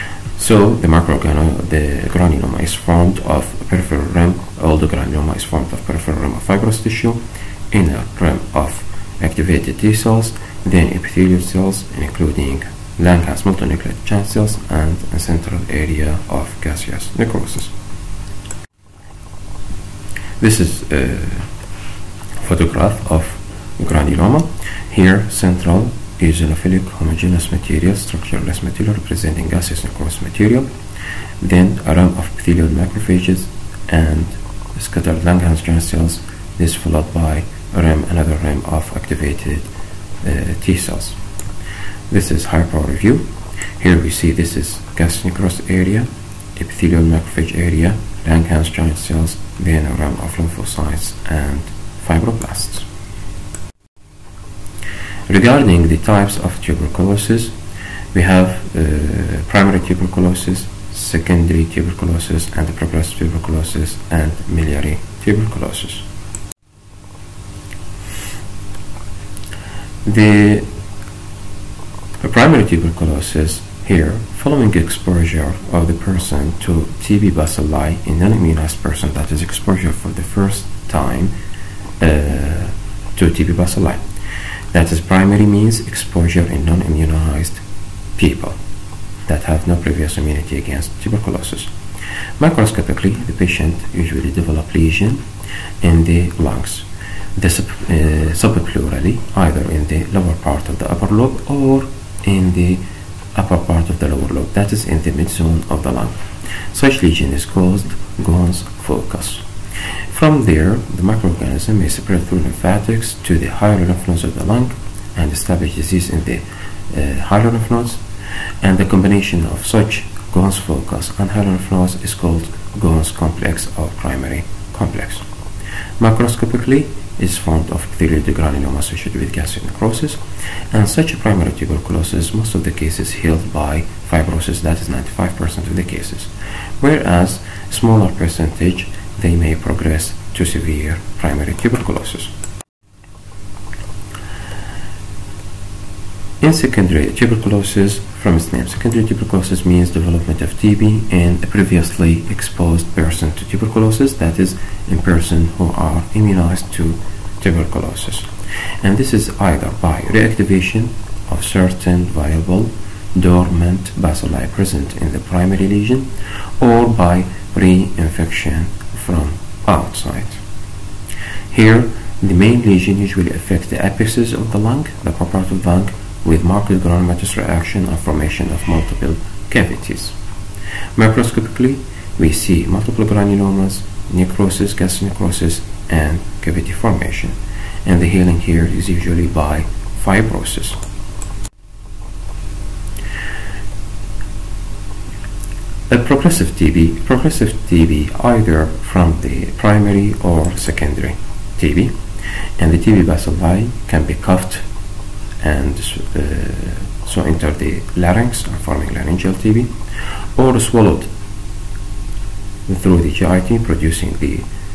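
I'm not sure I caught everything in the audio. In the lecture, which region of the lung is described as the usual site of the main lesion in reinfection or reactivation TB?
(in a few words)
The apexes.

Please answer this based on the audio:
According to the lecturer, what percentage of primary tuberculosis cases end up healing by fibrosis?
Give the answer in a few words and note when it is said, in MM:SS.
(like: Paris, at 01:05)
95%, at 02:14.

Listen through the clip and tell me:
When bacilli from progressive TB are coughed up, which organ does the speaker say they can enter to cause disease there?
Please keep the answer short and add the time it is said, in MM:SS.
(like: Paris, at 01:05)
Larynx, at 03:27.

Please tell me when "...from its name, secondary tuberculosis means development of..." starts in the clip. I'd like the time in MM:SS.
02:28.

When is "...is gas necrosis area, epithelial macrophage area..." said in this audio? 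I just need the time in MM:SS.
00:44.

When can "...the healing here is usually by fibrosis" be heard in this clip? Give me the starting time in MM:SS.
03:08.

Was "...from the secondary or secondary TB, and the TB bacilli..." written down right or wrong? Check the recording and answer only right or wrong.
wrong.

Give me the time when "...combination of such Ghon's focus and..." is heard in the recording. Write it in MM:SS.
01:58.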